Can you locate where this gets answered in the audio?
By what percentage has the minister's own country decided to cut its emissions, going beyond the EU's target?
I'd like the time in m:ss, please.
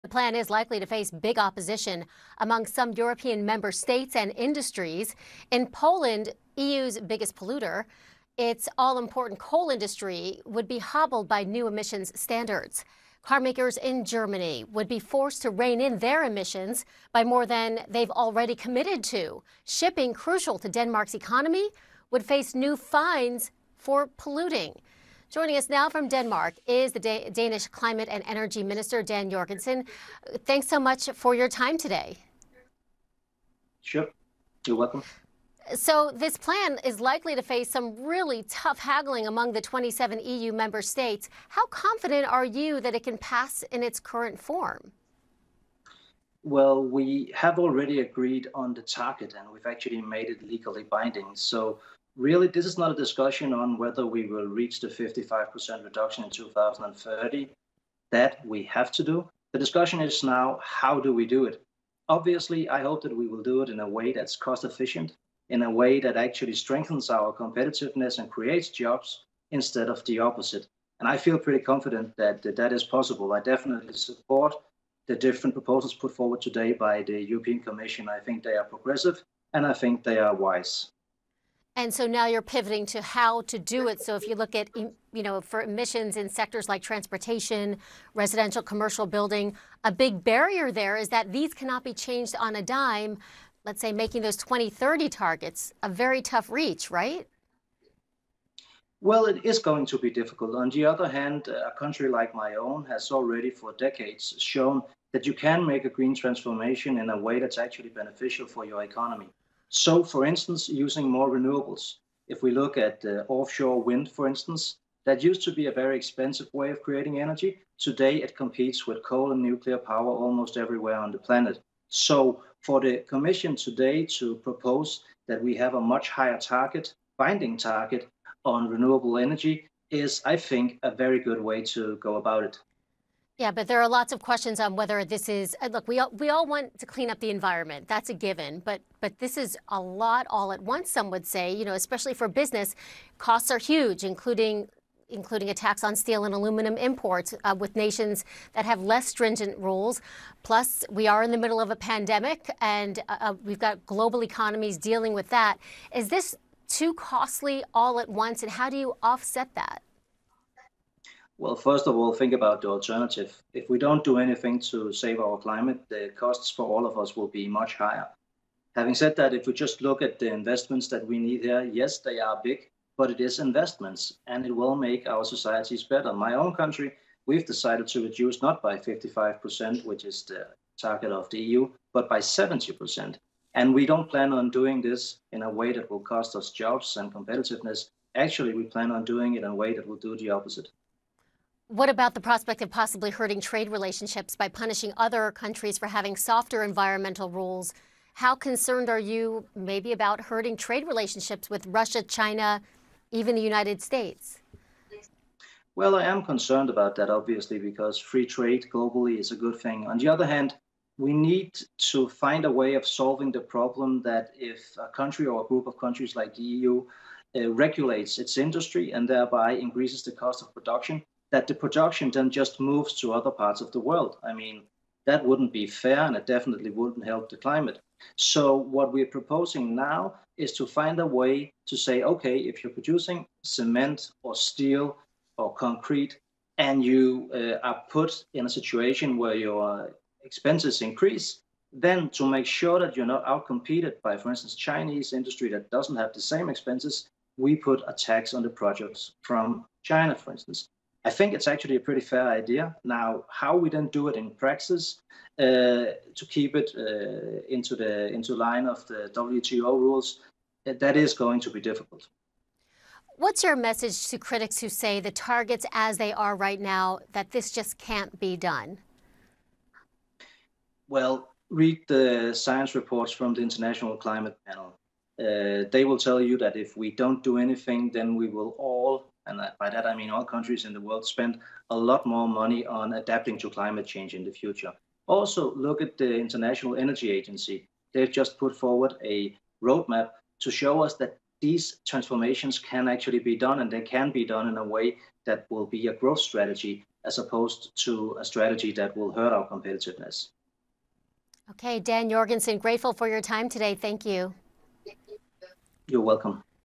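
3:02.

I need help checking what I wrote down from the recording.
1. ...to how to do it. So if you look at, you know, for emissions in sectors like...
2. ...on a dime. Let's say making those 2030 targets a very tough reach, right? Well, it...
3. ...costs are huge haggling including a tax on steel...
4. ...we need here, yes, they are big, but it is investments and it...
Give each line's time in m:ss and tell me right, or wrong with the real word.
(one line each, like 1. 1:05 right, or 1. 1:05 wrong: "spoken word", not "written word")
1. 1:22 right
2. 1:32 right
3. 2:23 wrong: "including", not "haggling"
4. 2:51 right.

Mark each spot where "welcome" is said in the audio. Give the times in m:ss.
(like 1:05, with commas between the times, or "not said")
0:34, 5:06.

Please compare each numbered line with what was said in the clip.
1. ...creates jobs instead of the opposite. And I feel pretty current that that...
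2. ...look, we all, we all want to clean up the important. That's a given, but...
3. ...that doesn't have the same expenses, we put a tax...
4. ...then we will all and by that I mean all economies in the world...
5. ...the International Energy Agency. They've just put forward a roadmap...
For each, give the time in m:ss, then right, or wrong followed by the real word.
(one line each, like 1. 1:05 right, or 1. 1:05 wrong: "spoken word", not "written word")
1. 1:08 wrong: "confident", not "current"
2. 2:15 wrong: "environment", not "important"
3. 4:05 right
4. 4:37 wrong: "countries", not "economies"
5. 4:45 right.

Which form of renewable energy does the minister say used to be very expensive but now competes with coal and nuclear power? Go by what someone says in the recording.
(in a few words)
Offshore wind.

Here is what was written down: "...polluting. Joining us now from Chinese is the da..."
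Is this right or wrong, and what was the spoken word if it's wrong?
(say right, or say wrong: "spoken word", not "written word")
wrong: "Denmark", not "Chinese".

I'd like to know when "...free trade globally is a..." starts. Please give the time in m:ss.
3:27.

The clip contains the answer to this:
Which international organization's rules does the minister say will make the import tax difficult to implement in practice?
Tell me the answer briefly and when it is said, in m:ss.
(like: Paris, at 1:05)
WTO, at 4:19.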